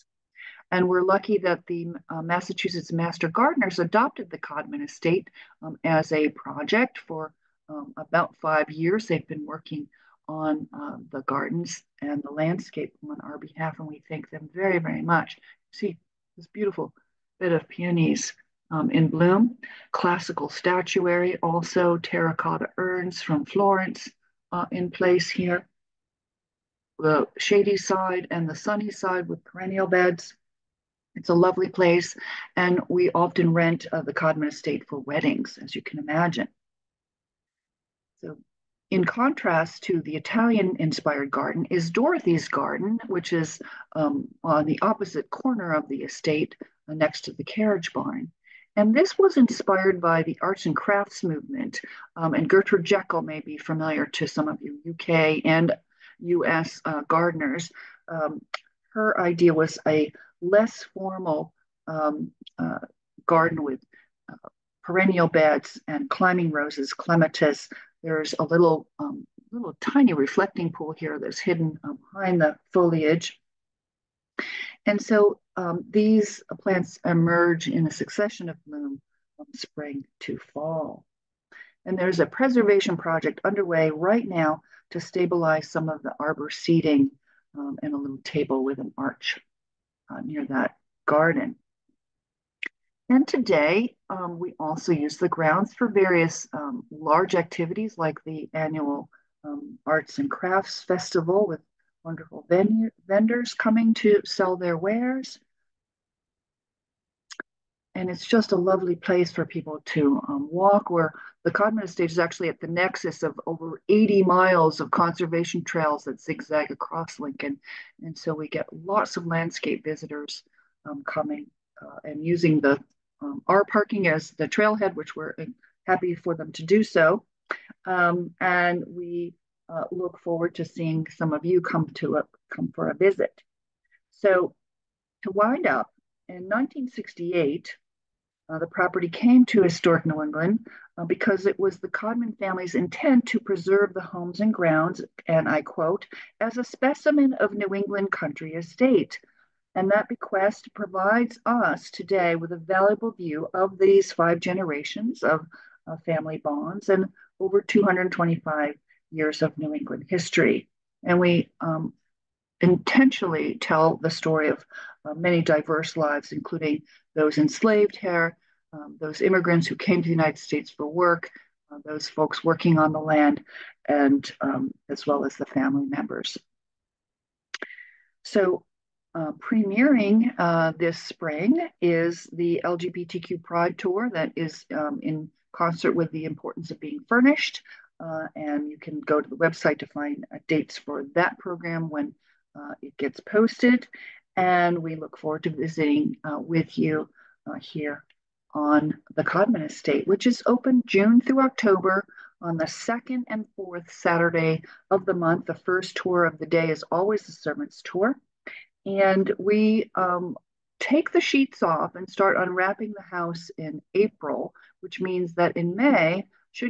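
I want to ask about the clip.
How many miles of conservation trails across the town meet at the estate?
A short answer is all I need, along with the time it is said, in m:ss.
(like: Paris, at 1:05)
over 80 miles, at 1:53.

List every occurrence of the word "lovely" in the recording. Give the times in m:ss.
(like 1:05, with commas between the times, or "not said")
0:31, 1:48.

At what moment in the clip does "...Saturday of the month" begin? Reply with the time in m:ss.
3:23.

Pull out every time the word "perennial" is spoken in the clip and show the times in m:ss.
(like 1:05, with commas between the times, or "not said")
0:29, 1:04.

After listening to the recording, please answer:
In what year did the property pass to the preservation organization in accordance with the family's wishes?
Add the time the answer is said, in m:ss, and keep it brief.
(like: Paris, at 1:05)
1968, at 2:16.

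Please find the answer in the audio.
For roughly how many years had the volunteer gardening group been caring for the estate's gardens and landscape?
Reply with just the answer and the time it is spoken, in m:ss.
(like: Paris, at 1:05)
5 years, at 0:08.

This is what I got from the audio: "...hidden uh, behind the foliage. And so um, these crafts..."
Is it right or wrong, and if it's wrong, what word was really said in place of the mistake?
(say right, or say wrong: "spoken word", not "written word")
wrong: "plants", not "crafts".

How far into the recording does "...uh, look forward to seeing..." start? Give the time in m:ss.
2:09.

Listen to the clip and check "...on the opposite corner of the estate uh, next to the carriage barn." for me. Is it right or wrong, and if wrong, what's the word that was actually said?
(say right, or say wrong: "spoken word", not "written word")
right.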